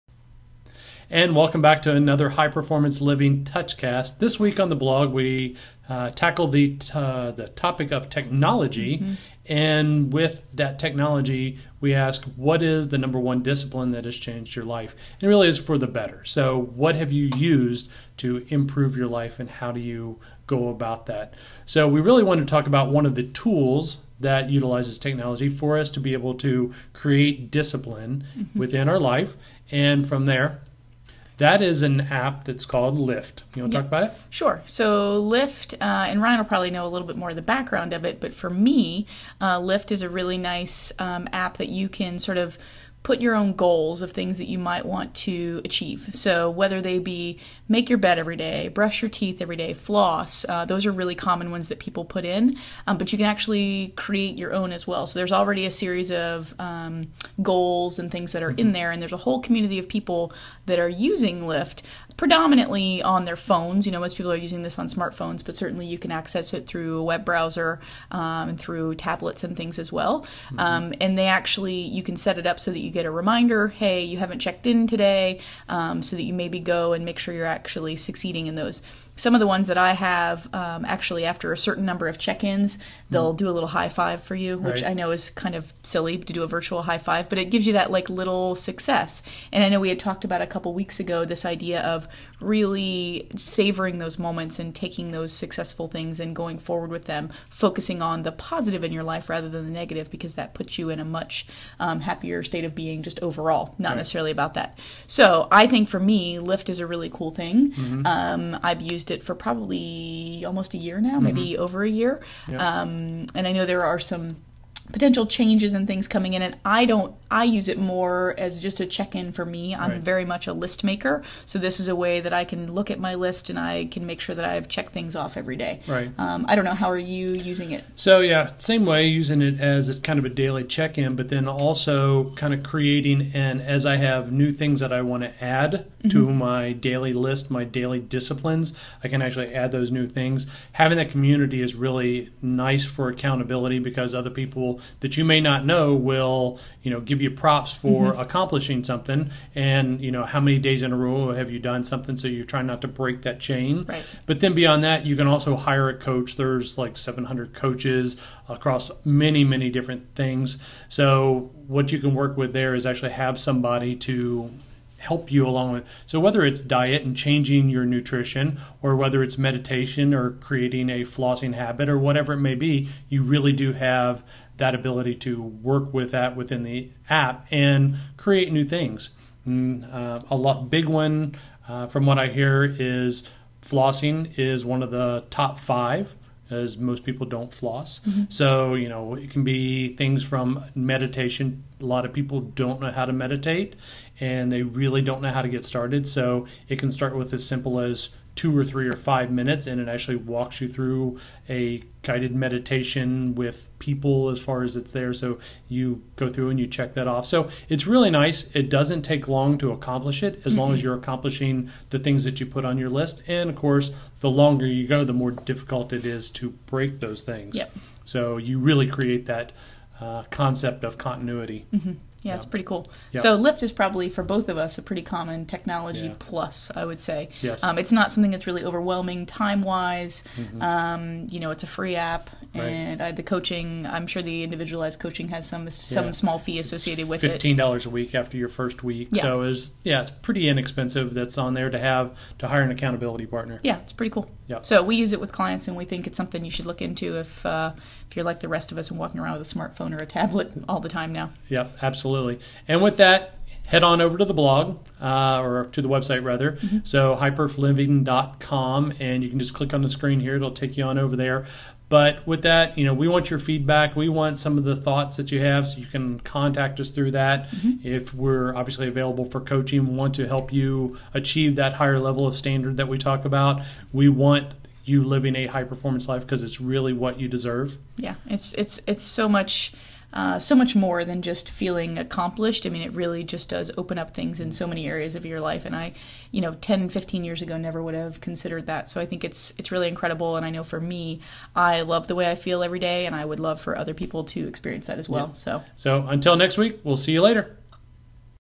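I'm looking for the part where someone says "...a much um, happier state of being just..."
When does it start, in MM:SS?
01:40.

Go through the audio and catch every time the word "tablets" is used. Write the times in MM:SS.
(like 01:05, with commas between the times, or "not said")
01:08, 04:10.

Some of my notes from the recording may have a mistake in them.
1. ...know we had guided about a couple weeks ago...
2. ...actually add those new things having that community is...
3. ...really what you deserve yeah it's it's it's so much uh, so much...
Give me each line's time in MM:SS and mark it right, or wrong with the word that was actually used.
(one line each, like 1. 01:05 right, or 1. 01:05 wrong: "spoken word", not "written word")
1. 01:29 wrong: "talked", not "guided"
2. 02:19 right
3. 04:36 right.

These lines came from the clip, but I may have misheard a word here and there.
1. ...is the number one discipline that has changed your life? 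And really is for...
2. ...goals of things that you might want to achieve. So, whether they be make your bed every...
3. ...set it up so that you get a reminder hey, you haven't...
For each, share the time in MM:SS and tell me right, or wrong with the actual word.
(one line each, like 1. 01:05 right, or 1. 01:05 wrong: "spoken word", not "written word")
1. 00:12 right
2. 00:43 right
3. 01:12 right.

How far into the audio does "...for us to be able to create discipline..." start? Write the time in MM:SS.
00:25.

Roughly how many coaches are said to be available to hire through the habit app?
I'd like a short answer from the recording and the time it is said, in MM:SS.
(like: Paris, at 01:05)
700, at 02:36.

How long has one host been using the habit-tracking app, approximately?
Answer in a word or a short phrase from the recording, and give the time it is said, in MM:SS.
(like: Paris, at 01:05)
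almost a year, at 01:50.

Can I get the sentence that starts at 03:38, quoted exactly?
so you really create that uh, concept of continuity mm-hmm.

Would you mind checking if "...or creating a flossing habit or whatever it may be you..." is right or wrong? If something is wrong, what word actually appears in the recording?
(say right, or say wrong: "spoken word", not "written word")
right.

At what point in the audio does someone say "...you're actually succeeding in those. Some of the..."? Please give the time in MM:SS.
01:17.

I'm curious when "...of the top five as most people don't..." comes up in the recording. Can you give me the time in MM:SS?
03:04.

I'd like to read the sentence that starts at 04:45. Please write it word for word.
And I, you know, 10, 15 years ago, never would have considered that.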